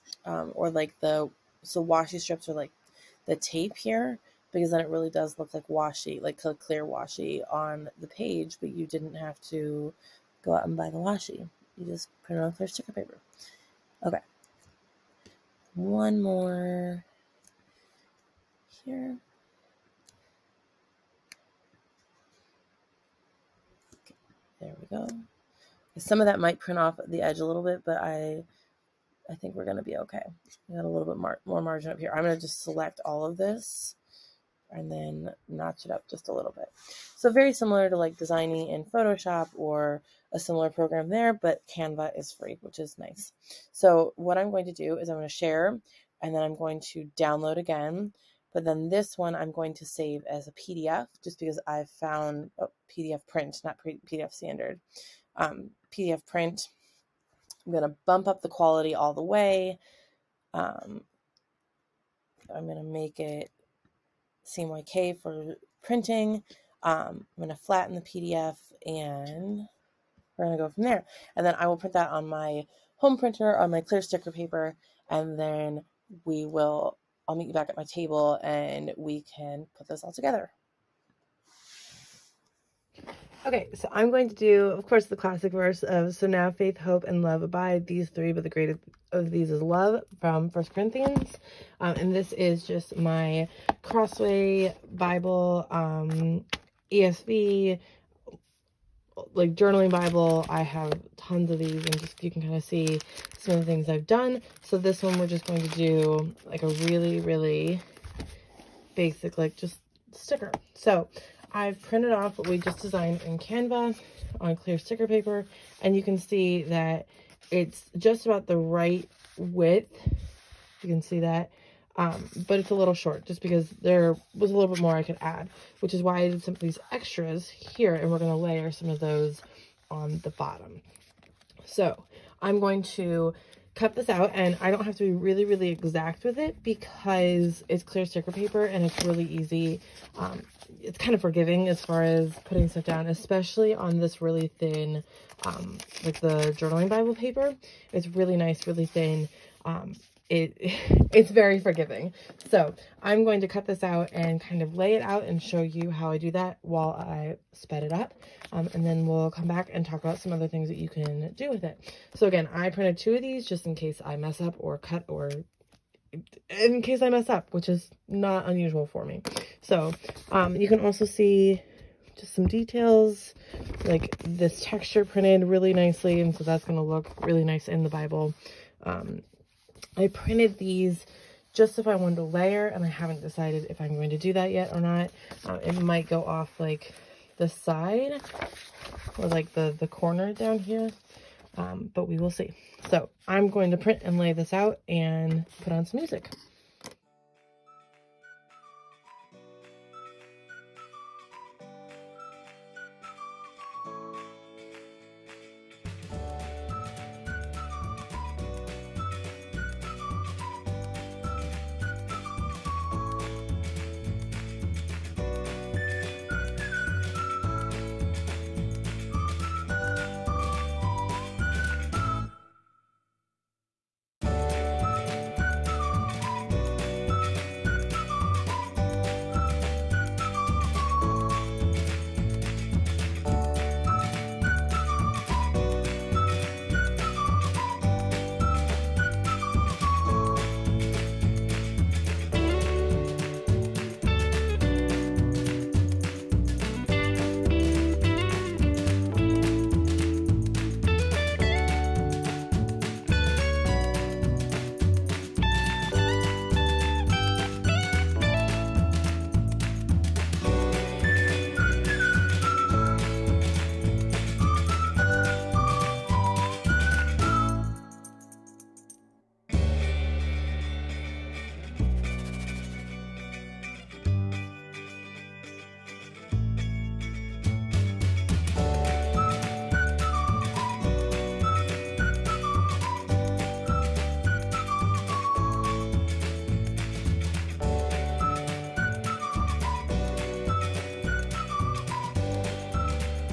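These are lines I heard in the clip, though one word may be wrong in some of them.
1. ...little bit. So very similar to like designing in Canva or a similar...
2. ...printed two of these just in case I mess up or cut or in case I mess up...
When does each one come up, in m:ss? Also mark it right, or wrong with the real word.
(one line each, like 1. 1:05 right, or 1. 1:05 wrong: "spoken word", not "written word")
1. 0:36 wrong: "Photoshop", not "Canva"
2. 2:42 right.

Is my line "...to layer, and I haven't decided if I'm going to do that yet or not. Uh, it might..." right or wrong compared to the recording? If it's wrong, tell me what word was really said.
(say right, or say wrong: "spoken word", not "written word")
right.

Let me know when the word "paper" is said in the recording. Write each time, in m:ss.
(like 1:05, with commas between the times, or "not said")
0:12, 1:14, 1:55, 2:18, 2:27.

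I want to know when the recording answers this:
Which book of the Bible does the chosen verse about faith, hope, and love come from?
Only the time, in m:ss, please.
1:30.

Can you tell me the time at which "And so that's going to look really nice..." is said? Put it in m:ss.
2:56.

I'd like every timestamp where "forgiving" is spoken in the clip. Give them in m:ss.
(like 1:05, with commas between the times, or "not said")
2:21, 2:31.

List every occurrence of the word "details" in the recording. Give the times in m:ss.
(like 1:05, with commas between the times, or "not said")
2:52.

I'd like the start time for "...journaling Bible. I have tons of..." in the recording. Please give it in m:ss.
1:39.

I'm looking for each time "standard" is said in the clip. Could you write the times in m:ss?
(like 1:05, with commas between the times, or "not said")
0:54.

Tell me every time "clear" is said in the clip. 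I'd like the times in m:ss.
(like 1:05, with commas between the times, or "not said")
0:06, 0:12, 1:13, 1:54, 2:17.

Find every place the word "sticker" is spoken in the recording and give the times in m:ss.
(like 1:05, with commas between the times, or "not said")
0:12, 1:14, 1:50, 1:54, 2:18.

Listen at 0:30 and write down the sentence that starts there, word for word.
We got a little bit mar more margin up here.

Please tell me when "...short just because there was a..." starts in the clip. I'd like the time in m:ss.
2:02.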